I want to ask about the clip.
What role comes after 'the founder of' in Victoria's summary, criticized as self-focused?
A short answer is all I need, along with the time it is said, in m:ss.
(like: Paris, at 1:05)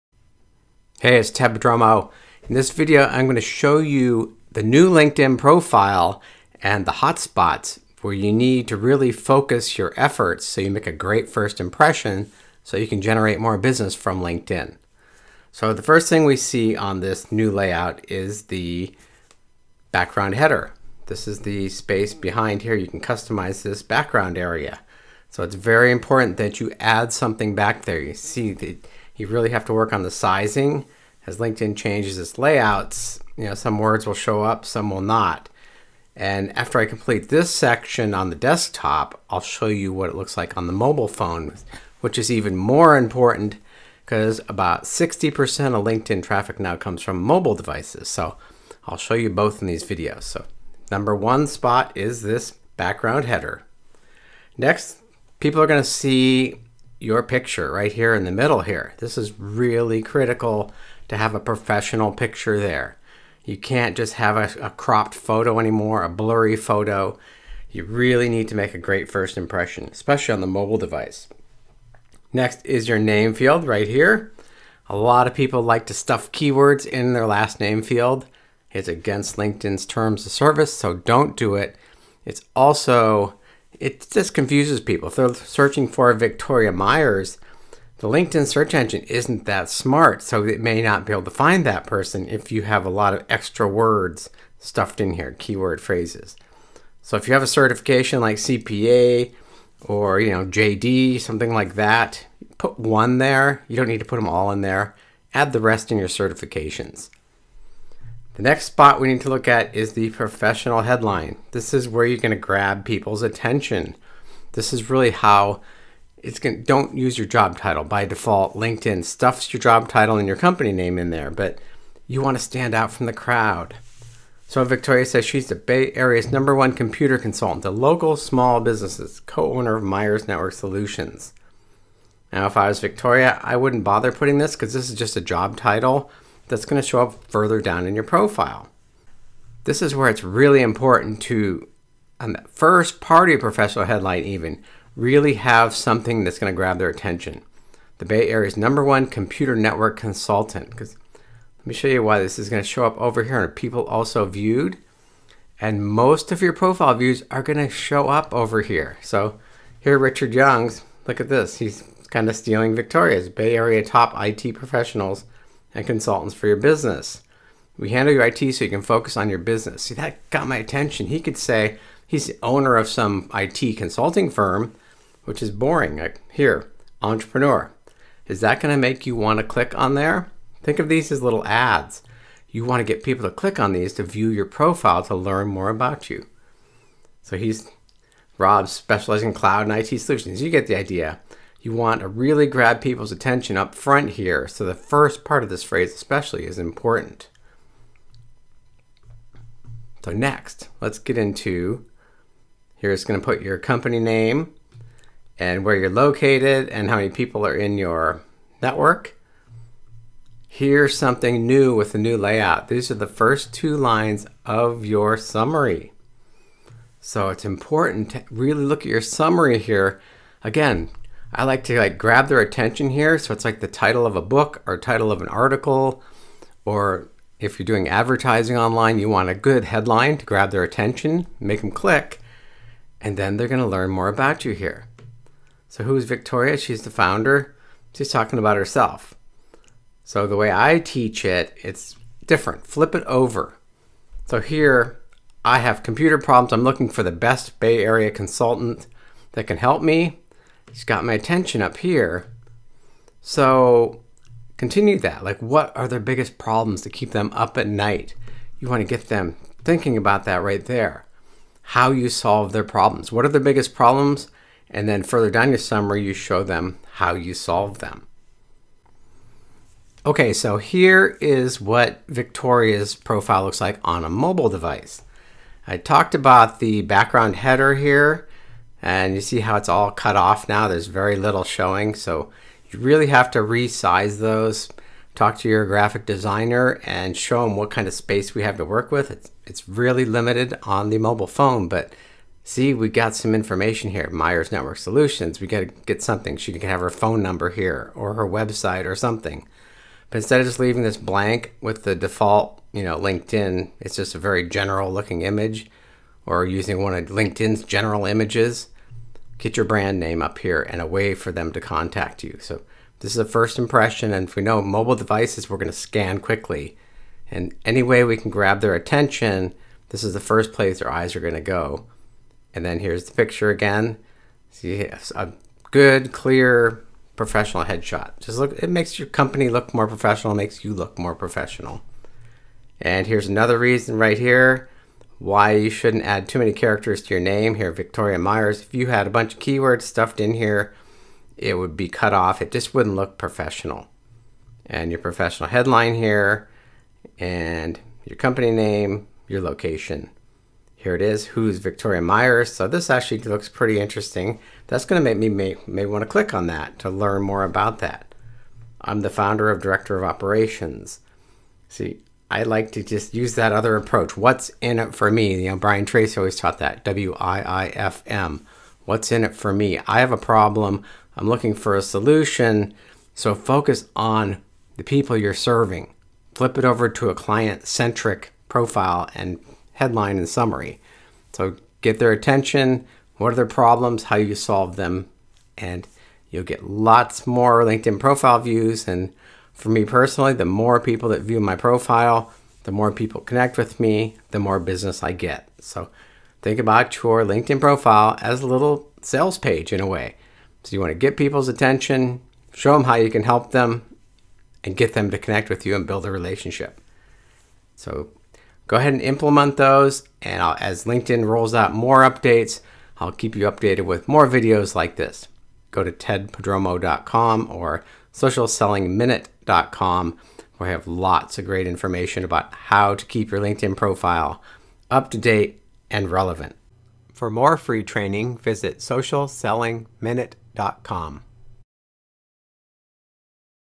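Director of Operations, at 5:59.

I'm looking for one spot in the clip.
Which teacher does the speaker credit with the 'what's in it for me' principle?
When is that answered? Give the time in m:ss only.
6:05.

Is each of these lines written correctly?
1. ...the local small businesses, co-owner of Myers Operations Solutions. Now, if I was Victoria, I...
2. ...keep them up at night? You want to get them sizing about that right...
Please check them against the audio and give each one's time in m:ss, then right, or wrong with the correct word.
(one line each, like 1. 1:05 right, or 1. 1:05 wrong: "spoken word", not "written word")
1. 2:07 wrong: "Network", not "Operations"
2. 4:16 wrong: "thinking", not "sizing".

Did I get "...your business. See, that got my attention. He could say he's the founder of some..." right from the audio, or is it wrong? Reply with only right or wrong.
wrong.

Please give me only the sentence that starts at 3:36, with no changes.
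So it's important to really look at your summary here.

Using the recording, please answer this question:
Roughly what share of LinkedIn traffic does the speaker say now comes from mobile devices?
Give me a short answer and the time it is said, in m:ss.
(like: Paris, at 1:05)
60%, at 0:44.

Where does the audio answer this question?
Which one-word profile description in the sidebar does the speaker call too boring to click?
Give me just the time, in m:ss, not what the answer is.
2:57.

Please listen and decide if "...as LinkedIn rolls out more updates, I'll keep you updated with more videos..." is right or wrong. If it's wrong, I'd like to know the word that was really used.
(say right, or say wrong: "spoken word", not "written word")
right.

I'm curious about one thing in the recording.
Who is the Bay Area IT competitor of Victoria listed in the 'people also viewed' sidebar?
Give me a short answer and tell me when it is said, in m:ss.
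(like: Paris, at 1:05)
Richard Young, at 2:39.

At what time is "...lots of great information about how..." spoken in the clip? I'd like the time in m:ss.
7:00.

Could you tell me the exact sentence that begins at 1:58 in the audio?
LinkedIn stuffs your job title and your company name in there, but you want to stand out from the crowd.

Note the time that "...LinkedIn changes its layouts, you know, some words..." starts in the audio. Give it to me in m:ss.
0:31.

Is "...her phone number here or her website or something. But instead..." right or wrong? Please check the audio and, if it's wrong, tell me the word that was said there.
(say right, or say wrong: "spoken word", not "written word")
right.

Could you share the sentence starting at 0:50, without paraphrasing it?
So number one spot is this background header.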